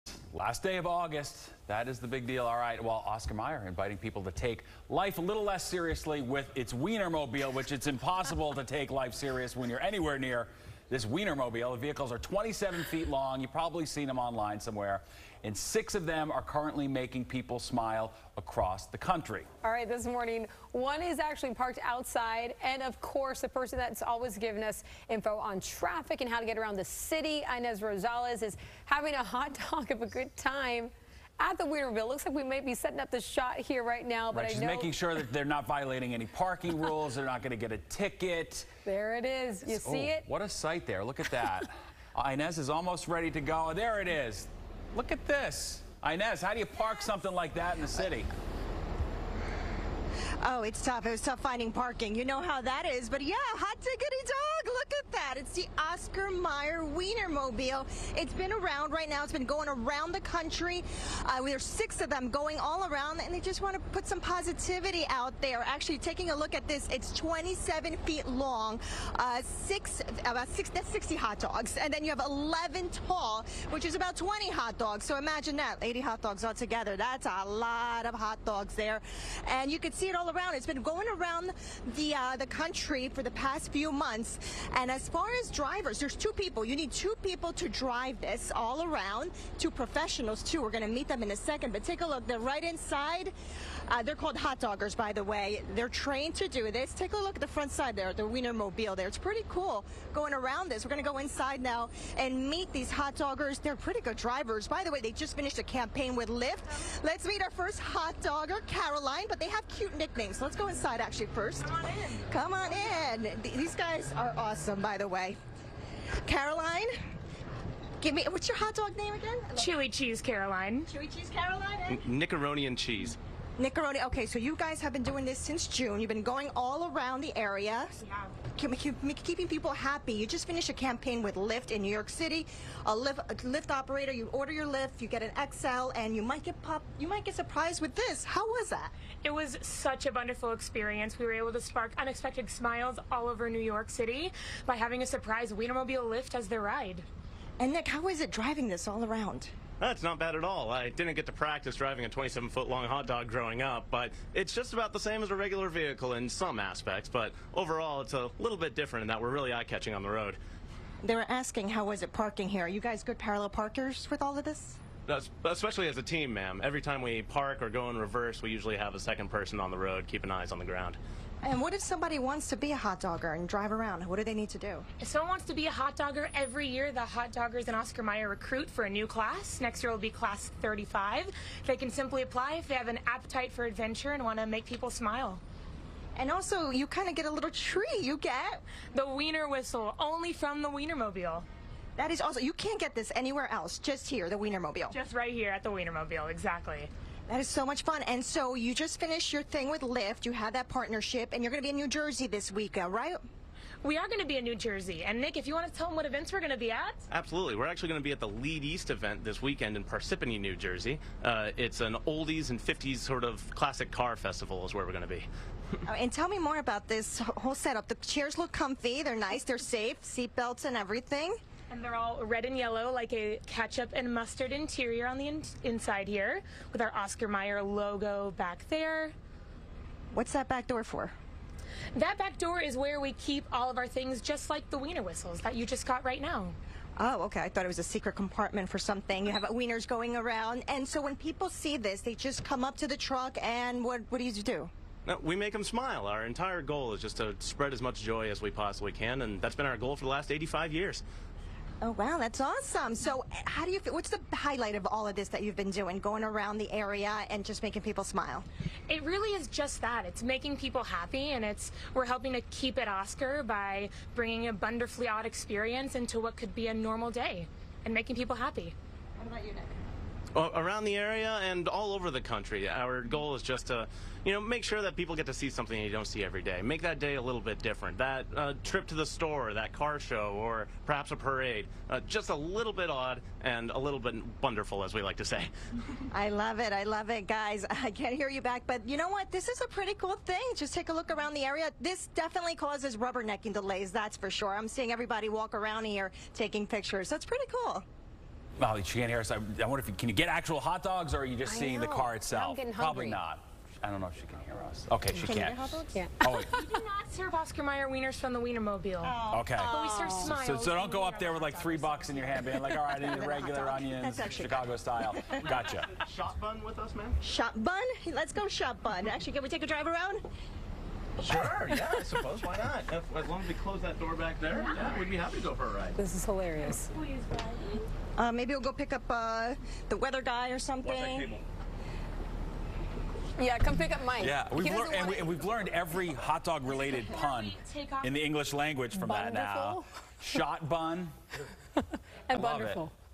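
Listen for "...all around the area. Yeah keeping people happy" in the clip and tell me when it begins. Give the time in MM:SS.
02:06.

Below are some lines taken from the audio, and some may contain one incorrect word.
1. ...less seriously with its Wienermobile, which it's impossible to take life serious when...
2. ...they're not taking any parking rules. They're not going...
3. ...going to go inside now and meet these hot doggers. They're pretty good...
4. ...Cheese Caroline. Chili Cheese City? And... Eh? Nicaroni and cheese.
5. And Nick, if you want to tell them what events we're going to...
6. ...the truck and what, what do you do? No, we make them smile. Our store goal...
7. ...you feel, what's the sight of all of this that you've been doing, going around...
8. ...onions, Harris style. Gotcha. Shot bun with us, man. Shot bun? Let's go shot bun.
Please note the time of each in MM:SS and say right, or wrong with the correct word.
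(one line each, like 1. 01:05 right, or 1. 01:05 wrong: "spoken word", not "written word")
1. 00:05 right
2. 00:35 wrong: "violating", not "taking"
3. 01:40 right
4. 01:59 wrong: "Caroline", not "City"
5. 03:25 right
6. 04:02 wrong: "entire", not "store"
7. 04:13 wrong: "highlight", not "sight"
8. 05:13 wrong: "Chicago", not "Harris".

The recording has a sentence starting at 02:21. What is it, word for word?
We were able to spark unexpected smiles all over New York City by having a surprise Wienermobile Lyft as their ride.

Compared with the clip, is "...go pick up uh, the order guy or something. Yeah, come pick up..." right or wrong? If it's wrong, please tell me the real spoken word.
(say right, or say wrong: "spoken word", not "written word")
wrong: "weather", not "order".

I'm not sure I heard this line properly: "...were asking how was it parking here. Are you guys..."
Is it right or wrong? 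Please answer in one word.
right.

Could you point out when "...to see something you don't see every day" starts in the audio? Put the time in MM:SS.
04:35.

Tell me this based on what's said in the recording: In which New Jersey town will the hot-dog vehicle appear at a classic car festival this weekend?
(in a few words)
Parsippany.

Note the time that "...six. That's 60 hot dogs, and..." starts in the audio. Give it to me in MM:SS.
01:10.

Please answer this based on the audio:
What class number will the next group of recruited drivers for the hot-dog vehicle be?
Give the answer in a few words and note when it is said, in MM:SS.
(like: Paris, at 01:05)
35, at 03:00.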